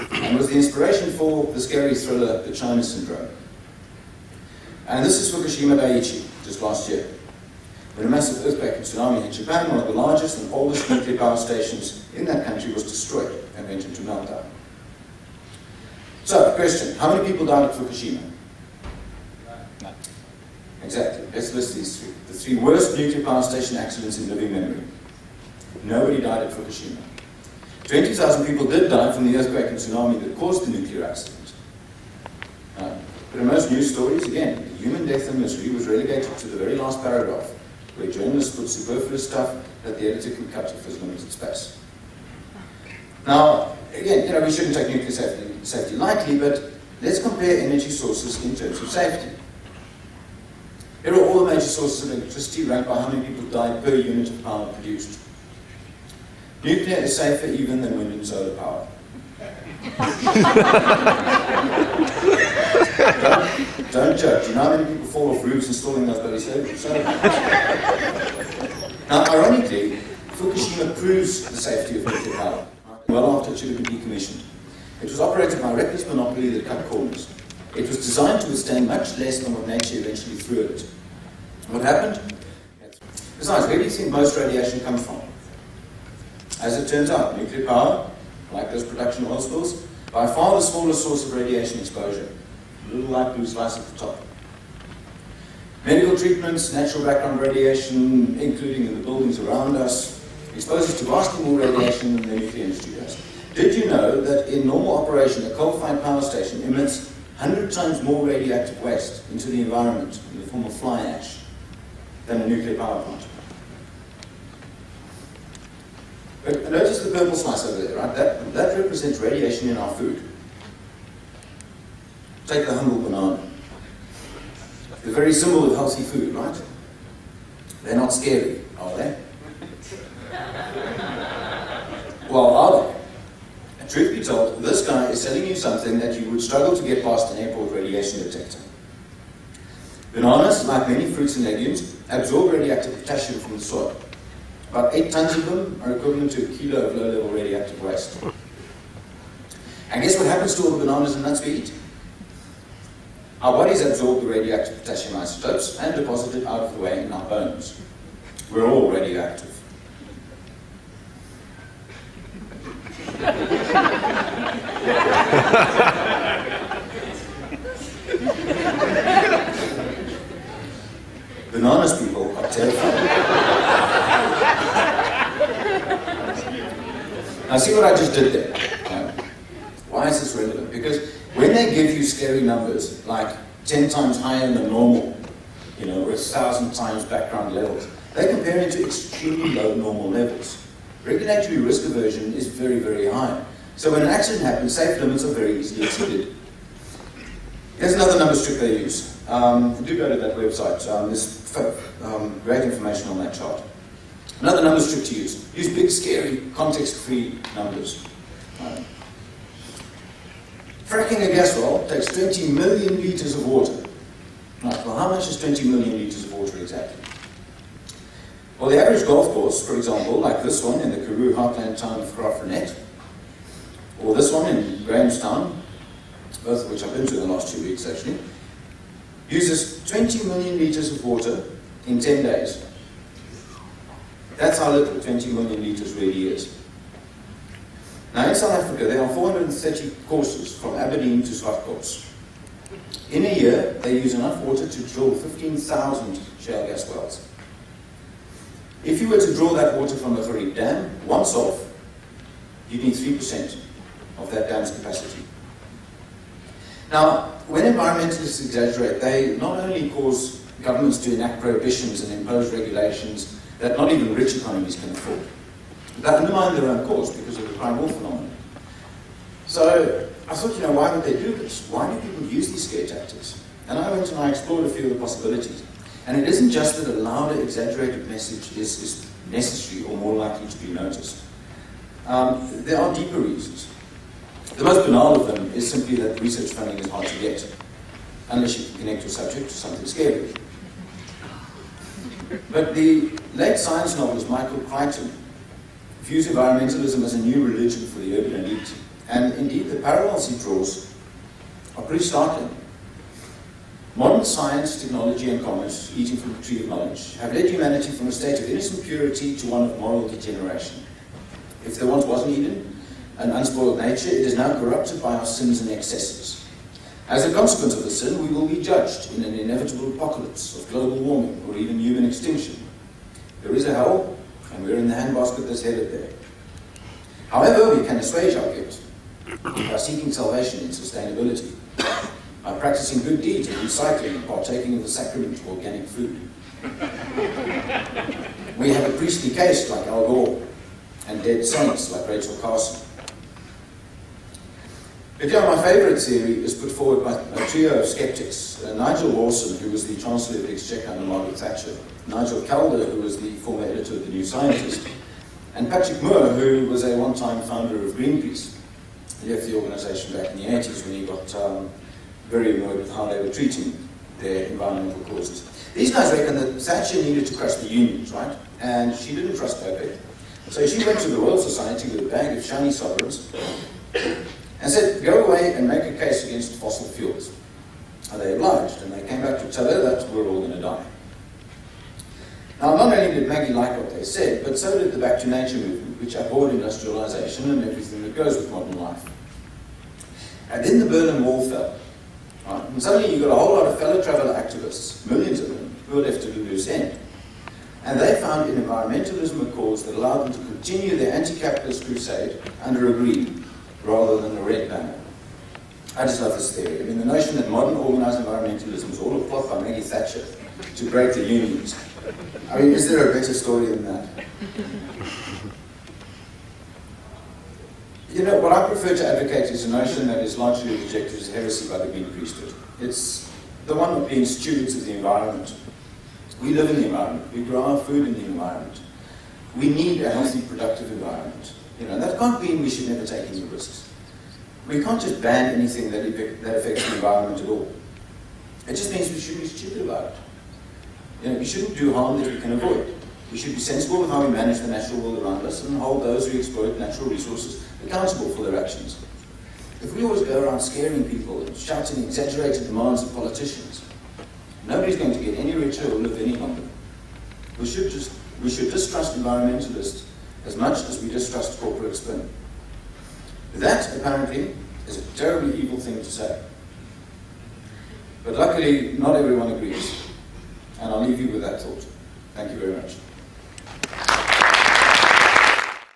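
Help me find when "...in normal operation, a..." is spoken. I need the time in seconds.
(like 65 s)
104 s.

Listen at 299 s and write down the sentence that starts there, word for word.
And indeed, the parallels he draws are pretty startling.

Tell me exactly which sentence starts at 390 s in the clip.
And then the Berlin Wall fell.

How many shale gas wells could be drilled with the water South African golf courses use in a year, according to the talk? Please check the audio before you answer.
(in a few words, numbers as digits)
15,000.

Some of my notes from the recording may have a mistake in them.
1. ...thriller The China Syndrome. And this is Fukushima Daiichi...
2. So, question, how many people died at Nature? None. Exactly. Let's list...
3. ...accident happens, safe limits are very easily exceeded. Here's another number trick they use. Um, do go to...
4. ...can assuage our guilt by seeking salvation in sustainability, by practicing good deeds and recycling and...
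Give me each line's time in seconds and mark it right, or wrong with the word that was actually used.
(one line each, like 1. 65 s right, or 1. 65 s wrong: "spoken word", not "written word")
1. 1 s right
2. 16 s wrong: "Fukushima", not "Nature"
3. 194 s right
4. 327 s right.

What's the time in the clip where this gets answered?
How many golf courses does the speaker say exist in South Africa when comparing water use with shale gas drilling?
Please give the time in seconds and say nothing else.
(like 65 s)
239 s.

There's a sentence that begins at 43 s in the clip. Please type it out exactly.
Now, again, you know, we shouldn't take nuclear safety, safety lightly, but let's compare energy sources in terms of safety.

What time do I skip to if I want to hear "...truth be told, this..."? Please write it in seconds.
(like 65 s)
133 s.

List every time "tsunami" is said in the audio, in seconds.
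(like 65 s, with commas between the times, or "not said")
8 s, 29 s.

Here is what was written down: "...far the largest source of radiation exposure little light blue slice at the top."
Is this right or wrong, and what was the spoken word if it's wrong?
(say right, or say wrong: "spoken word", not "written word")
wrong: "smallest", not "largest".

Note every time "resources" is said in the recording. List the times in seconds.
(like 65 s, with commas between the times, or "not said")
447 s.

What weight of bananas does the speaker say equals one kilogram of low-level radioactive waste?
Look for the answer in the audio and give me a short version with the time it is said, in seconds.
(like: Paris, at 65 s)
8 tons, at 144 s.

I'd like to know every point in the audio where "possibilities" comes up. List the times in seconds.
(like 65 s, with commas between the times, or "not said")
274 s.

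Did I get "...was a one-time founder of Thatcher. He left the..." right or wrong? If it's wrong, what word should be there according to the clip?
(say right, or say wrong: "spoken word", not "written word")
wrong: "Greenpeace", not "Thatcher".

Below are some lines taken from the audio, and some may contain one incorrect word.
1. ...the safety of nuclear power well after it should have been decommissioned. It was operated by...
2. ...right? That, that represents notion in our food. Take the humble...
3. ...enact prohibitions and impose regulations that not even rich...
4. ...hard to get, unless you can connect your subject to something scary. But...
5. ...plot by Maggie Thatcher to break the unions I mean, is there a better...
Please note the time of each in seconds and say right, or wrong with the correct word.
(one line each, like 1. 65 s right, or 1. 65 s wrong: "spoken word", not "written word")
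1. 71 s right
2. 117 s wrong: "radiation", not "notion"
3. 261 s right
4. 286 s right
5. 409 s right.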